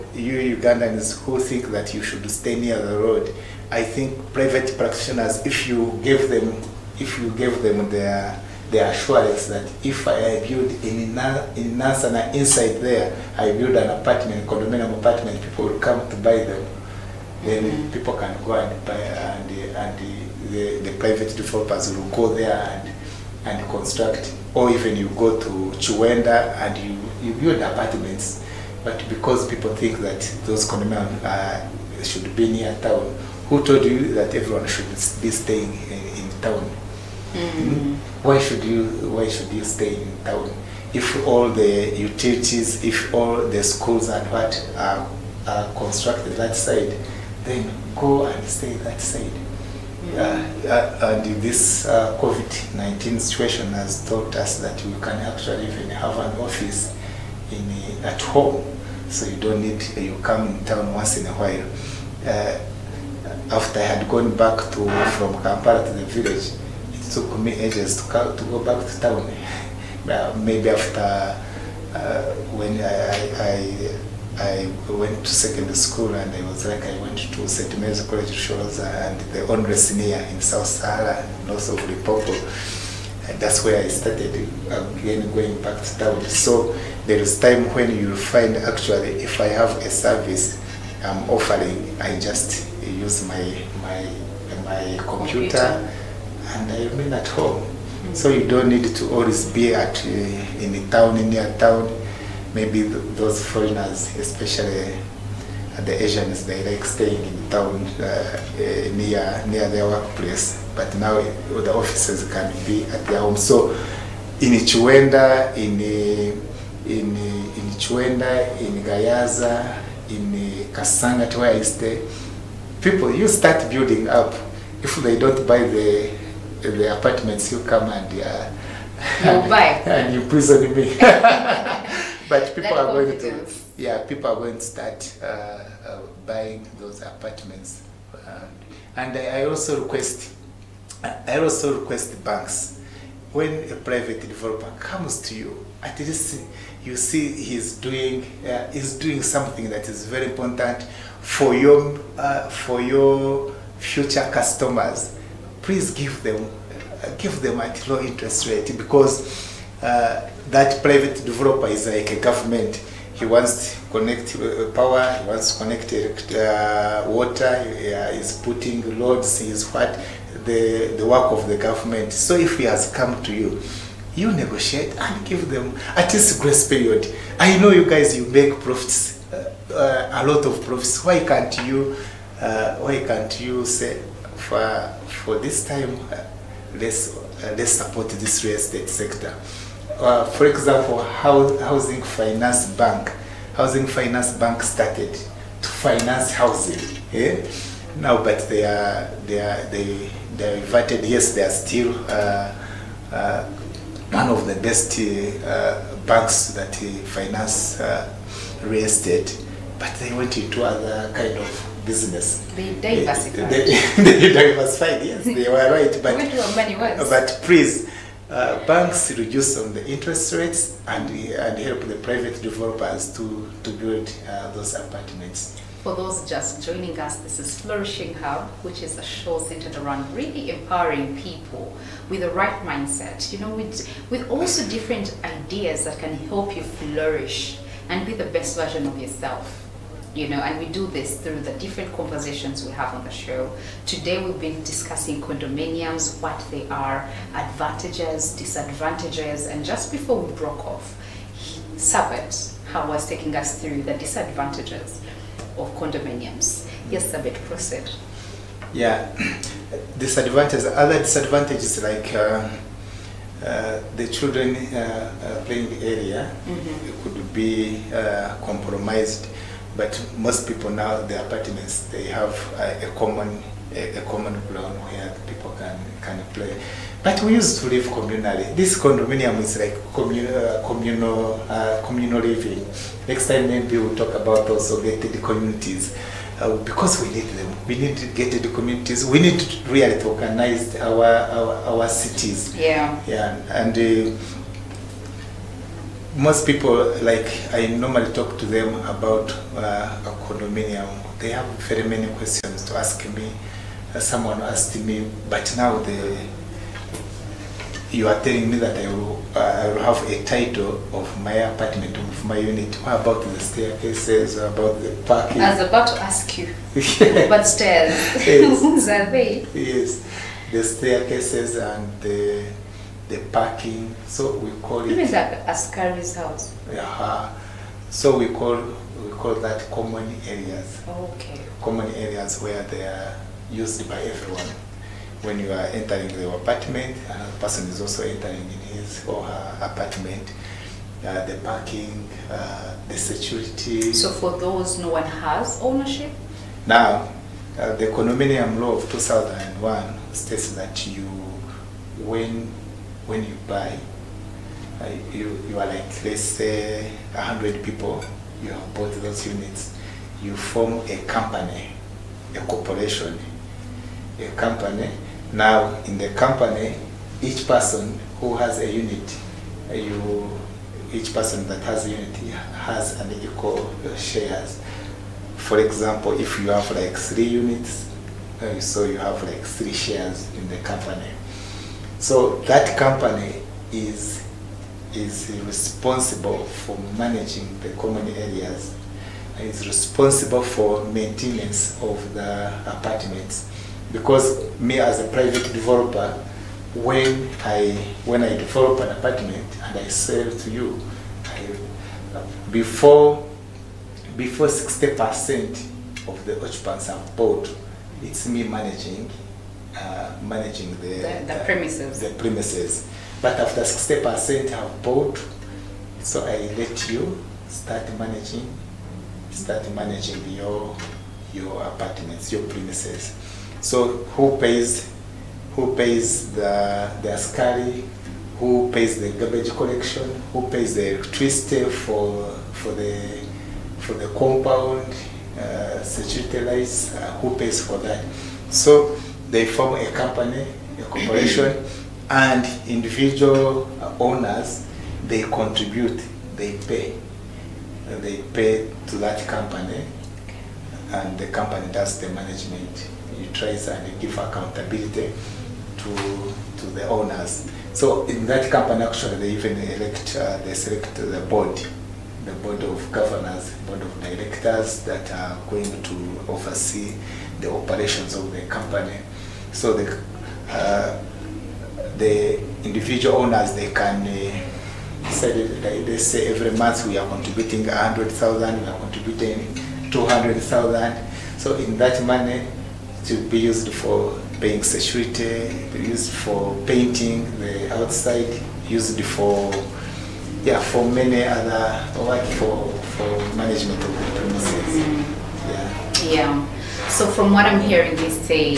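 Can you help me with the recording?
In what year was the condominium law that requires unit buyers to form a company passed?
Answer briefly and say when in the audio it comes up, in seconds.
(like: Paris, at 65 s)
2001, at 348 s.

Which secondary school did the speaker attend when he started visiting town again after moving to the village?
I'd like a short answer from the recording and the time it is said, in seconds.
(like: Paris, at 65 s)
St. Mary's College, at 77 s.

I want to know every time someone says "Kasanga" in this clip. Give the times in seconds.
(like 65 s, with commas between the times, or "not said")
120 s.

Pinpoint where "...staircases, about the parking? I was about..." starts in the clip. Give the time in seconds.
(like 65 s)
313 s.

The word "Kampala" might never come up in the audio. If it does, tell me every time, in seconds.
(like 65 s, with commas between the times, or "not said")
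65 s.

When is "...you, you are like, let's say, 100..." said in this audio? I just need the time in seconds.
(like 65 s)
355 s.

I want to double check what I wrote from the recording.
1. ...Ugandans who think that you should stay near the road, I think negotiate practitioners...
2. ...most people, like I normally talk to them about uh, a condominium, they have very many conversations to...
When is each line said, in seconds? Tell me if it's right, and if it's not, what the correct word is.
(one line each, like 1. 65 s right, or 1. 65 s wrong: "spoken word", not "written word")
1. 0 s wrong: "private", not "negotiate"
2. 296 s wrong: "questions", not "conversations".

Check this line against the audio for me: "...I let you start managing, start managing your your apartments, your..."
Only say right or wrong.
right.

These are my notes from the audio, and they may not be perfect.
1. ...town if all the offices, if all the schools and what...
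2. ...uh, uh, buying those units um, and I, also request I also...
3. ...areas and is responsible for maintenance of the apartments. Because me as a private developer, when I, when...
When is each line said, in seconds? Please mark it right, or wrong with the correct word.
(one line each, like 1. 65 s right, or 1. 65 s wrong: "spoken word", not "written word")
1. 40 s wrong: "utilities", not "offices"
2. 135 s wrong: "apartments", not "units"
3. 388 s right.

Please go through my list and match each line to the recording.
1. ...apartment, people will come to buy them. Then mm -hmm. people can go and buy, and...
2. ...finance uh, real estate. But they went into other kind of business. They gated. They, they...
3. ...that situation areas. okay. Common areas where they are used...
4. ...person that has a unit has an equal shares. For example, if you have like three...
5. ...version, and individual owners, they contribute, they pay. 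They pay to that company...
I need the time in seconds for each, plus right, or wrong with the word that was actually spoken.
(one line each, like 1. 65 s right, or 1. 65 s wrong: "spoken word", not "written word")
1. 14 s right
2. 207 s wrong: "diversified", not "gated"
3. 329 s wrong: "common", not "situation"
4. 371 s right
5. 440 s wrong: "corporation", not "version".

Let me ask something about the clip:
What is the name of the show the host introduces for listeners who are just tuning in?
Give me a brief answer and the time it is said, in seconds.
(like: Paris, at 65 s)
Flourishing Hub, at 227 s.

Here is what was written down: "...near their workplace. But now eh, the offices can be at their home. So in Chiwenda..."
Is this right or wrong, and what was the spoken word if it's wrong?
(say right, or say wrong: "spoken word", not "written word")
right.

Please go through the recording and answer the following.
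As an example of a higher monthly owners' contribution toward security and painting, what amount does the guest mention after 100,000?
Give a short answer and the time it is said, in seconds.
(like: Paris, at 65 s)
200,000, at 479 s.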